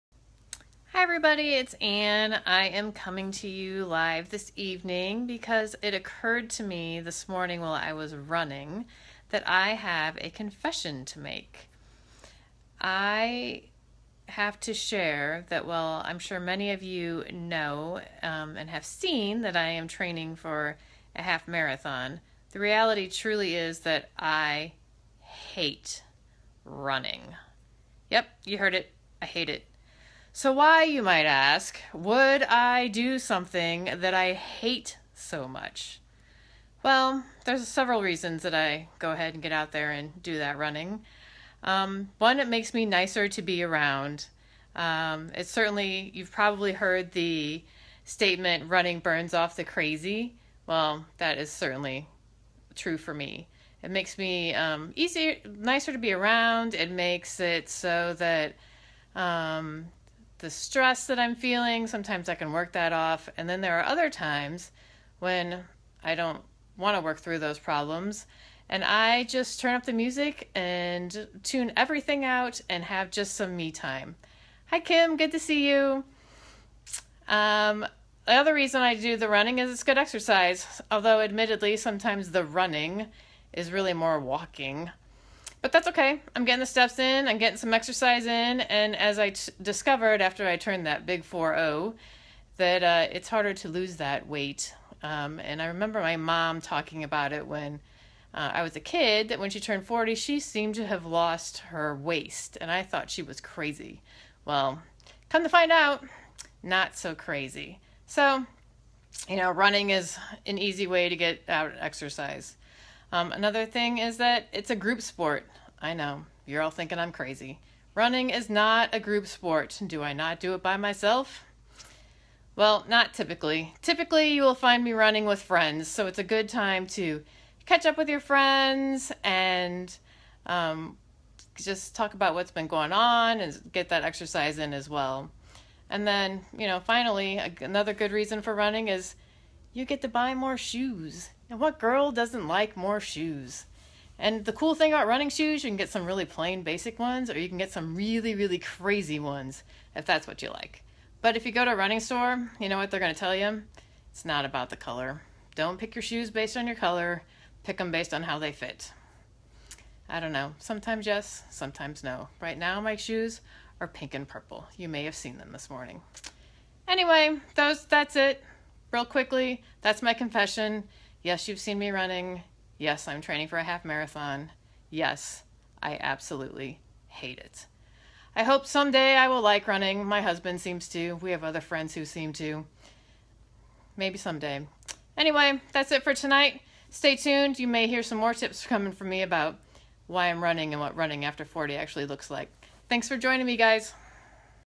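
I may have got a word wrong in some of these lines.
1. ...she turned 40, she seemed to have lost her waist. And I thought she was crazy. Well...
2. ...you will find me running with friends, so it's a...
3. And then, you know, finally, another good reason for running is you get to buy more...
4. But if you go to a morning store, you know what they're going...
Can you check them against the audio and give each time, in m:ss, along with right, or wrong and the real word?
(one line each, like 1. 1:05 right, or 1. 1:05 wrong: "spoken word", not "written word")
1. 1:39 right
2. 2:04 right
3. 2:15 right
4. 2:31 wrong: "running", not "morning".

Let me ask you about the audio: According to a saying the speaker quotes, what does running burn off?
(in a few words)
the crazy.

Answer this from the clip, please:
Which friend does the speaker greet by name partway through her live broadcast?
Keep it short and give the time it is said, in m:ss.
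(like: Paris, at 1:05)
Kim, at 1:14.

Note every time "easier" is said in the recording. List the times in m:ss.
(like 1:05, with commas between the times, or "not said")
0:54.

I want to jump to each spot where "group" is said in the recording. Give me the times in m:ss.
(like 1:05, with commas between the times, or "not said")
1:54, 1:59.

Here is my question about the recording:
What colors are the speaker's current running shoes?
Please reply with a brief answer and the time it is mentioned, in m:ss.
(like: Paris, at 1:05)
pink and purple, at 2:43.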